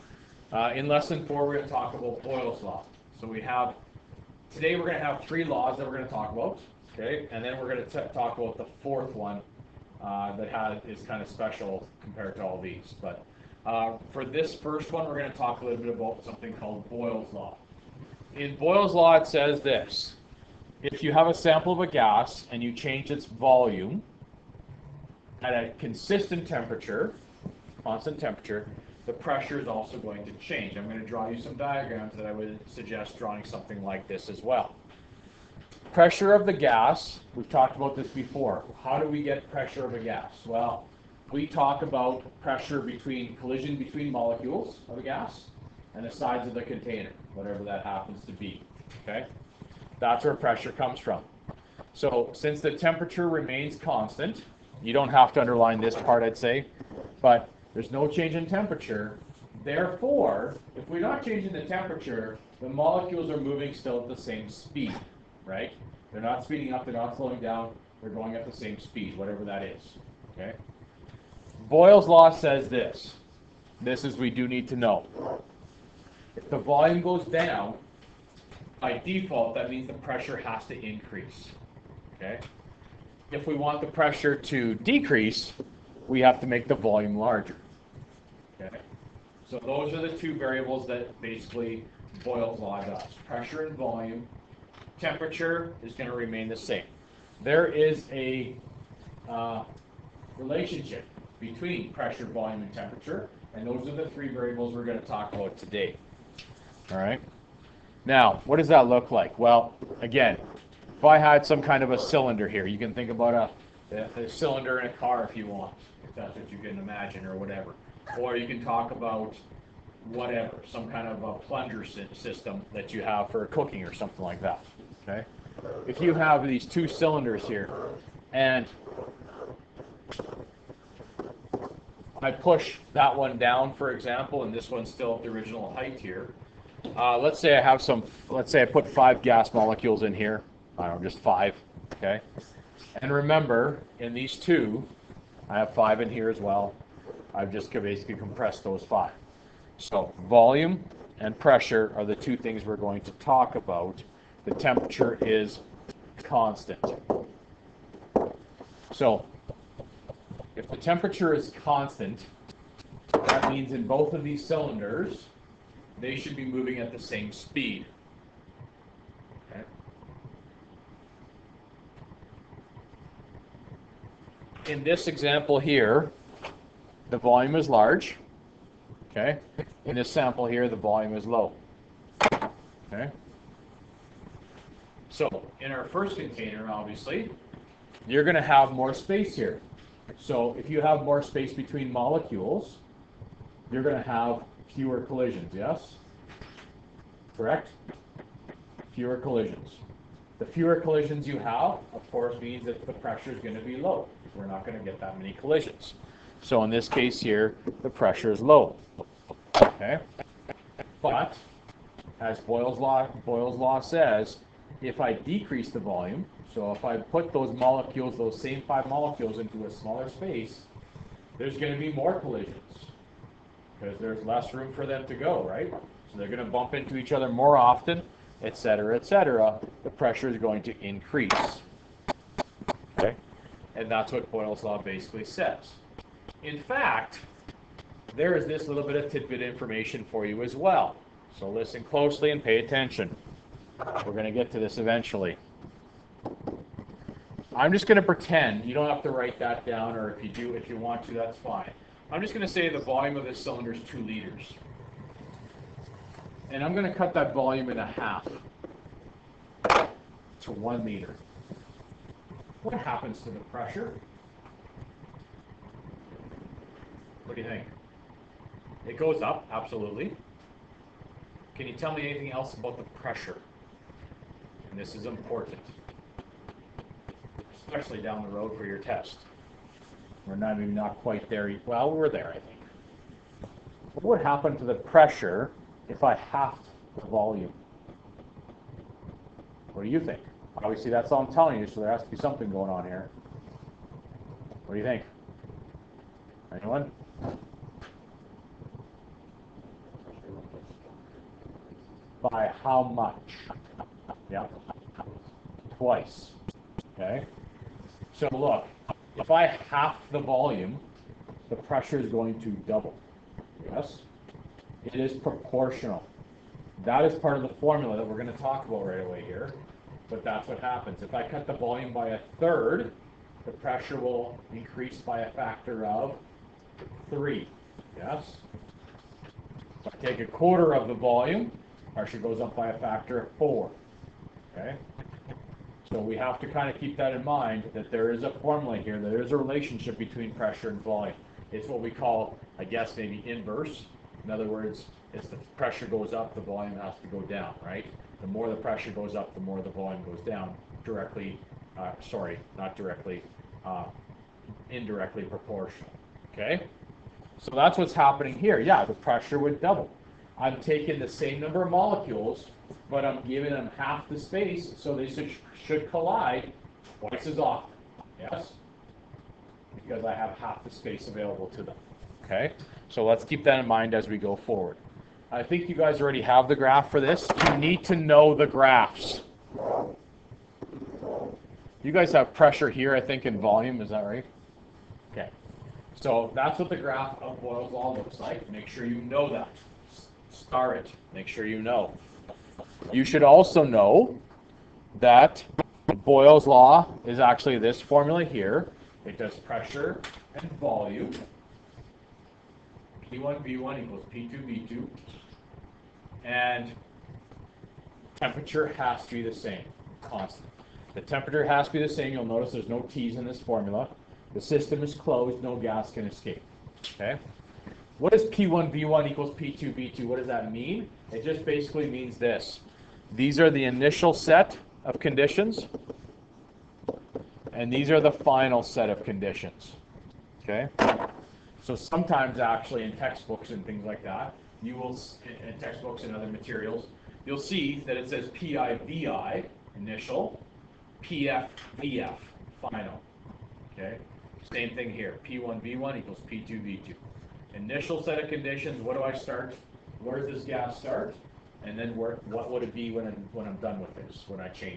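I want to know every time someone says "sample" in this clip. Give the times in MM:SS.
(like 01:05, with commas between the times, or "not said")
00:21, 03:00.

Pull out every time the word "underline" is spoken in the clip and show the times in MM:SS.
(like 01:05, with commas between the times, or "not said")
00:55.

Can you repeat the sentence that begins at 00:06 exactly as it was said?
Okay, and then we're going to talk about the fourth one uh, that has is kind of special compared to all these.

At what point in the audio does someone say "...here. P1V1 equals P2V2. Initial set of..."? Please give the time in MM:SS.
07:24.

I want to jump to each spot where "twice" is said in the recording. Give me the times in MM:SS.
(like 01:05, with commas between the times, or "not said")
05:05, 06:06.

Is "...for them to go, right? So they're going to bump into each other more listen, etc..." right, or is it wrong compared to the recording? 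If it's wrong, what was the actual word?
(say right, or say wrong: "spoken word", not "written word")
wrong: "often", not "listen".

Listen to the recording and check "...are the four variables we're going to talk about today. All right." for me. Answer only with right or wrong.
wrong.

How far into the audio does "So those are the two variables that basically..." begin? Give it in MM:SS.
01:29.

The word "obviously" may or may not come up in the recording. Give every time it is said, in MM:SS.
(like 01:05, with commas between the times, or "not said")
03:06, 04:50.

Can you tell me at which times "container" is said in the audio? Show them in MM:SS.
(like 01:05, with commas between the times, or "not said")
00:46, 03:06.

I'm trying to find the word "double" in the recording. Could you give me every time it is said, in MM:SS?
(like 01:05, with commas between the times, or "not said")
05:12, 05:59.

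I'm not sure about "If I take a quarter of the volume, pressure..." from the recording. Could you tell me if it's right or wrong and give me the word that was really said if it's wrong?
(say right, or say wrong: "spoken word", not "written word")
right.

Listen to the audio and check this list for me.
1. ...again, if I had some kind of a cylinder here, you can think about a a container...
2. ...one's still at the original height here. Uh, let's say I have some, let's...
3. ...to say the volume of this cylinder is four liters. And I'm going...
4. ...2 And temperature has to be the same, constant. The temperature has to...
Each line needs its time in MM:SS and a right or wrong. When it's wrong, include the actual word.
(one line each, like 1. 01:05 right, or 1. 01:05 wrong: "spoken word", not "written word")
1. 01:50 wrong: "cylinder", not "container"
2. 02:14 right
3. 04:12 wrong: "two", not "four"
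4. 06:44 right.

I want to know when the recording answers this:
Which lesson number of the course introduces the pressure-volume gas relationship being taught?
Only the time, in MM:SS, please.
00:00.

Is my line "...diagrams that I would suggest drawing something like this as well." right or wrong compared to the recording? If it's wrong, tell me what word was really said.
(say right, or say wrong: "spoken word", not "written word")
right.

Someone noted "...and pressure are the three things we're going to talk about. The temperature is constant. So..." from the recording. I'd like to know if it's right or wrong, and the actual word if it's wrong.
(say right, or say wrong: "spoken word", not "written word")
wrong: "two", not "three".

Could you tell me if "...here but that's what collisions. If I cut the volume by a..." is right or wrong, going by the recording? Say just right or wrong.
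wrong.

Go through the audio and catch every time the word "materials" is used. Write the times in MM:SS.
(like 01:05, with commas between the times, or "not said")
07:16.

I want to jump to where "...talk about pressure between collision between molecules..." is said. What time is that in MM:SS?
00:41.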